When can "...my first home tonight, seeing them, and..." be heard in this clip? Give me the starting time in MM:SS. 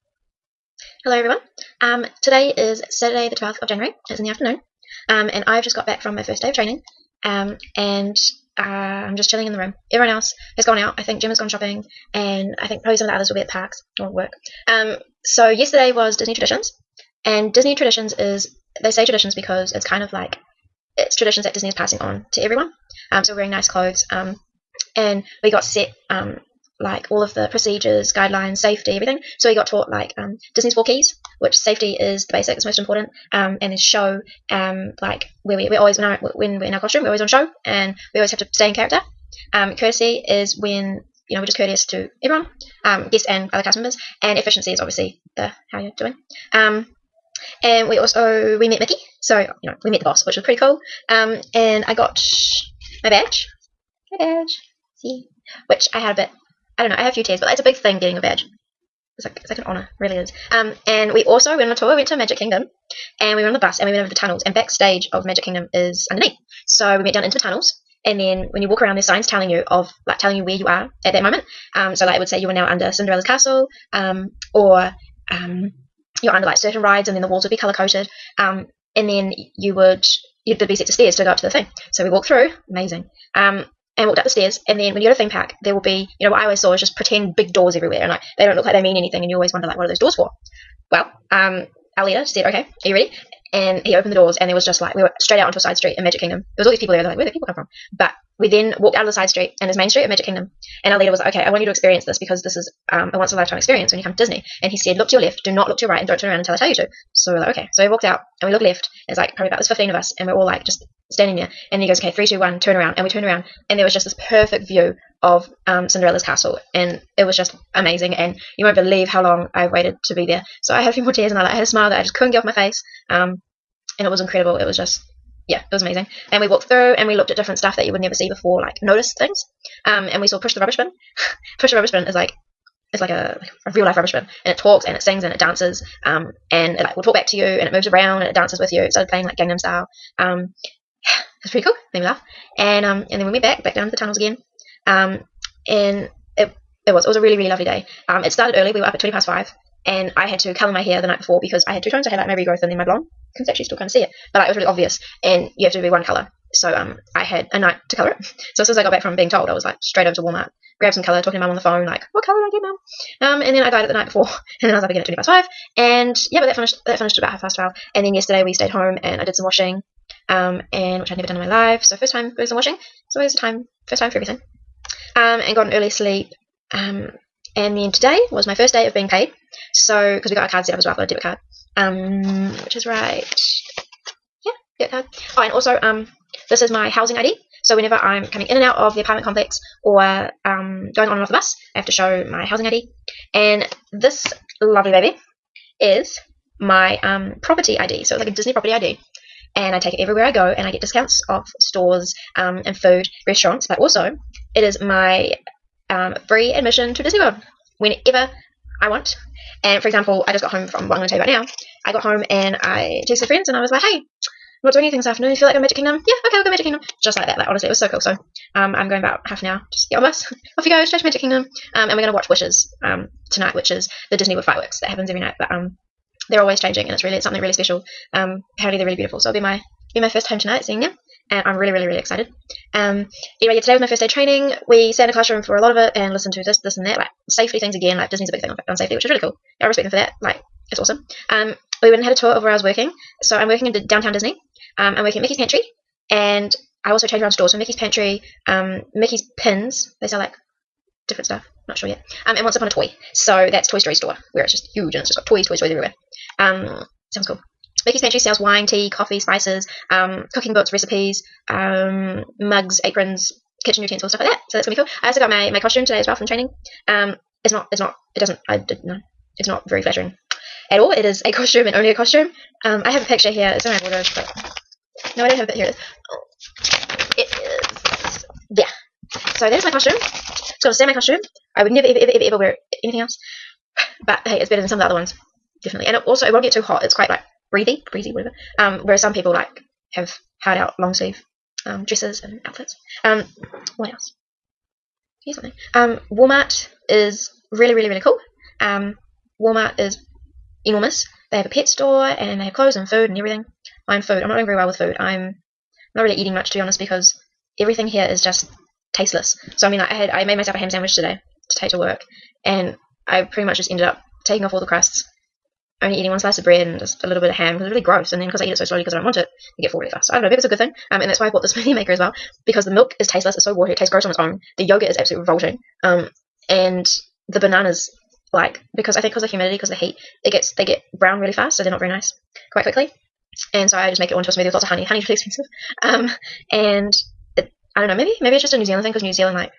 03:50.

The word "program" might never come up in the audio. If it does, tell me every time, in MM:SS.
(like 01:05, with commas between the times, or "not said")
not said.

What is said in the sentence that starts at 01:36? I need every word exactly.
There was all these people there.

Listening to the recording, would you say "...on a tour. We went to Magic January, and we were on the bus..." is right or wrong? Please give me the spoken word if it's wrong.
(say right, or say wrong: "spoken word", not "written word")
wrong: "Kingdom", not "January".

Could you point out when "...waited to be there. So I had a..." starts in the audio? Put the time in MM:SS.
01:59.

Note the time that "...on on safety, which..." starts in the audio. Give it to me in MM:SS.
03:58.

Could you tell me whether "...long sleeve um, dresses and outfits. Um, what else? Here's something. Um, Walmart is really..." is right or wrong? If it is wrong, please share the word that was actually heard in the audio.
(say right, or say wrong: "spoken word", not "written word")
right.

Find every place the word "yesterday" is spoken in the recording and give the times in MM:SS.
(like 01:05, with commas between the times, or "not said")
00:15, 02:48.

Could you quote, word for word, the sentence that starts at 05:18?
And then because I eat it so slowly because I don't want it, I get full really fast.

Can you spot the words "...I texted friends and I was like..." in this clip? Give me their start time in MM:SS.
03:32.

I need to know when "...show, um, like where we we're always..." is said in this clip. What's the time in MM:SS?
00:33.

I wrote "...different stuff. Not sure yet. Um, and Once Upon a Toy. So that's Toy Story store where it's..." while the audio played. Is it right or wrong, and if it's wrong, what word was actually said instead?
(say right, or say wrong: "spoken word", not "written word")
right.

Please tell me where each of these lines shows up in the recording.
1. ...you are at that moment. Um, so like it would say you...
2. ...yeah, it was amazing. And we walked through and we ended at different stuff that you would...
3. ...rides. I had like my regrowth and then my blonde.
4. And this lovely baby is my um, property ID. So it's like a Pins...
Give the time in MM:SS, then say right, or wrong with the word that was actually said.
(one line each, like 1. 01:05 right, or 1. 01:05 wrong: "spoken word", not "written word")
1. 01:10 right
2. 02:05 wrong: "looked", not "ended"
3. 02:31 wrong: "tones", not "rides"
4. 03:13 wrong: "Disney", not "Pins".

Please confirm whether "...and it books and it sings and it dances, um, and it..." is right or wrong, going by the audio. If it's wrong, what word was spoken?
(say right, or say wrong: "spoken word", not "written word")
wrong: "talks", not "books".